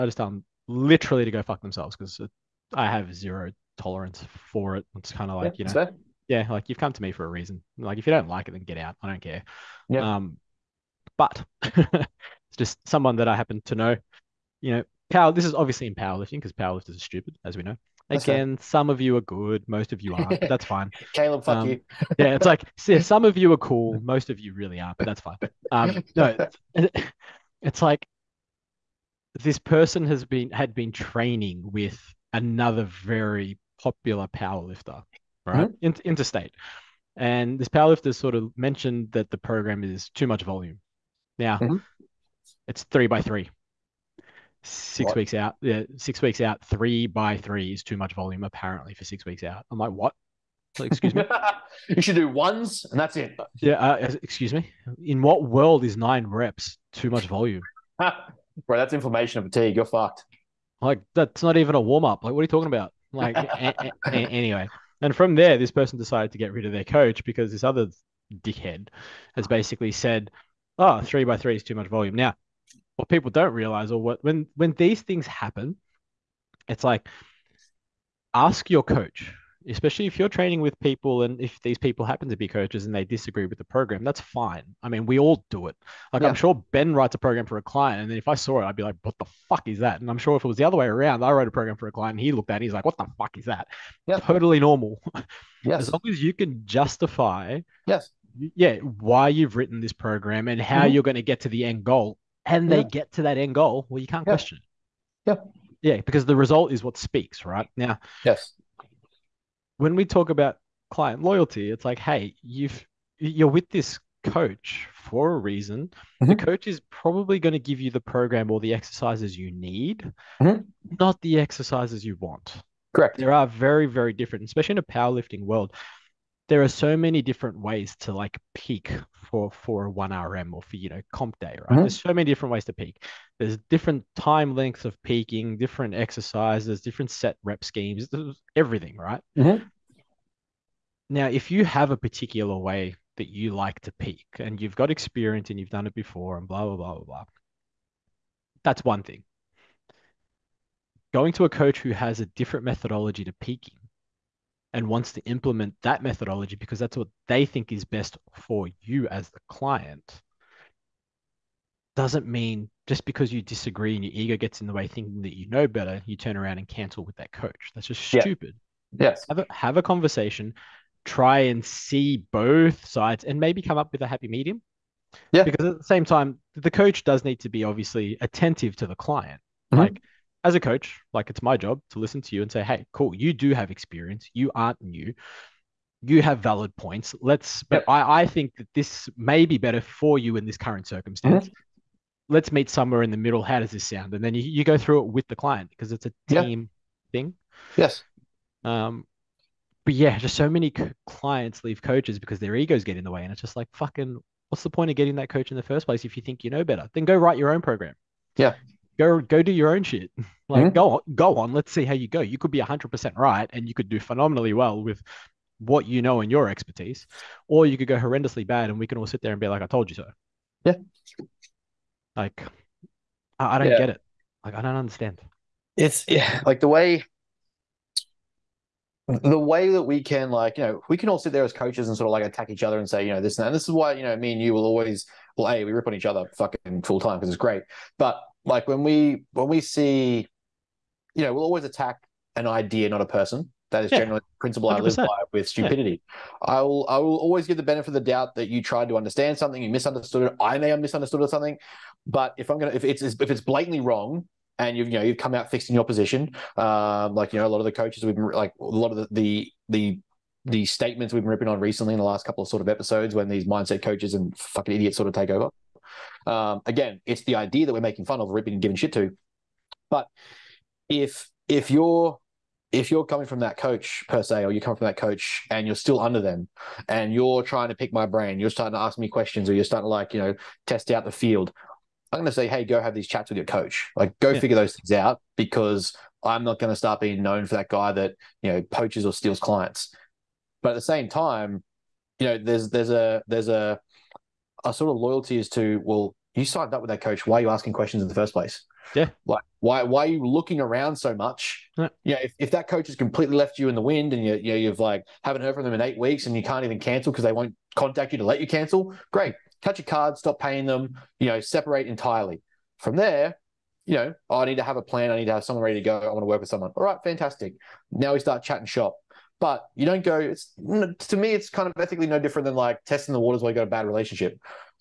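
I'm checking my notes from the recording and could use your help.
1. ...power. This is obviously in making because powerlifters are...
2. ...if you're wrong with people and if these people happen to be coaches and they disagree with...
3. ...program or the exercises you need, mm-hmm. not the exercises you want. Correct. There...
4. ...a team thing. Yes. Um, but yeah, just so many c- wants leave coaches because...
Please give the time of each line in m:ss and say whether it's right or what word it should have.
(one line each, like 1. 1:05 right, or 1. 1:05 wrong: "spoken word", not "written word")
1. 0:15 wrong: "powerlifting", not "making"
2. 1:20 wrong: "training", not "wrong"
3. 1:58 right
4. 3:16 wrong: "clients", not "wants".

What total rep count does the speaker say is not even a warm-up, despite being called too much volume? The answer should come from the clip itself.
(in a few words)
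9.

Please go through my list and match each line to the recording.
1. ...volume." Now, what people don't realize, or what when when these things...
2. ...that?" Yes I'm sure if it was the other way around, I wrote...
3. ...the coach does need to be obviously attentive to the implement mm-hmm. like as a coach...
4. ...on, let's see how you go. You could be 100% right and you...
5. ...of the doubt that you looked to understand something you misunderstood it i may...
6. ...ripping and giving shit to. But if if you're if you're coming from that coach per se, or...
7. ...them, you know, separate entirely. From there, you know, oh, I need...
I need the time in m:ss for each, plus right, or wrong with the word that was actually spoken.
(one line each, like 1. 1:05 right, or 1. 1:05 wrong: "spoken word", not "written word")
1. 1:11 right
2. 1:29 wrong: "And", not "Yes"
3. 2:56 wrong: "client", not "implement"
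4. 3:31 right
5. 4:07 wrong: "tried", not "looked"
6. 4:28 right
7. 5:10 right.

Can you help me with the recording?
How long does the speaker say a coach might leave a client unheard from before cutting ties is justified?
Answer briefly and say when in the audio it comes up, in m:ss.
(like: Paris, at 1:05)
8 weeks, at 5:05.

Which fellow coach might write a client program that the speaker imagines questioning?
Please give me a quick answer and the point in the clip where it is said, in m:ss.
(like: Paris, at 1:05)
Ben, at 1:26.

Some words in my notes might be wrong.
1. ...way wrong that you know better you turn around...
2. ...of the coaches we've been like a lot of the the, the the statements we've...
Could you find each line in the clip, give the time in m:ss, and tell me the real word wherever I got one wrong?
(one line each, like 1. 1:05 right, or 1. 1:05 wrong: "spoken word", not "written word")
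1. 2:44 wrong: "thinking", not "wrong"
2. 4:17 right.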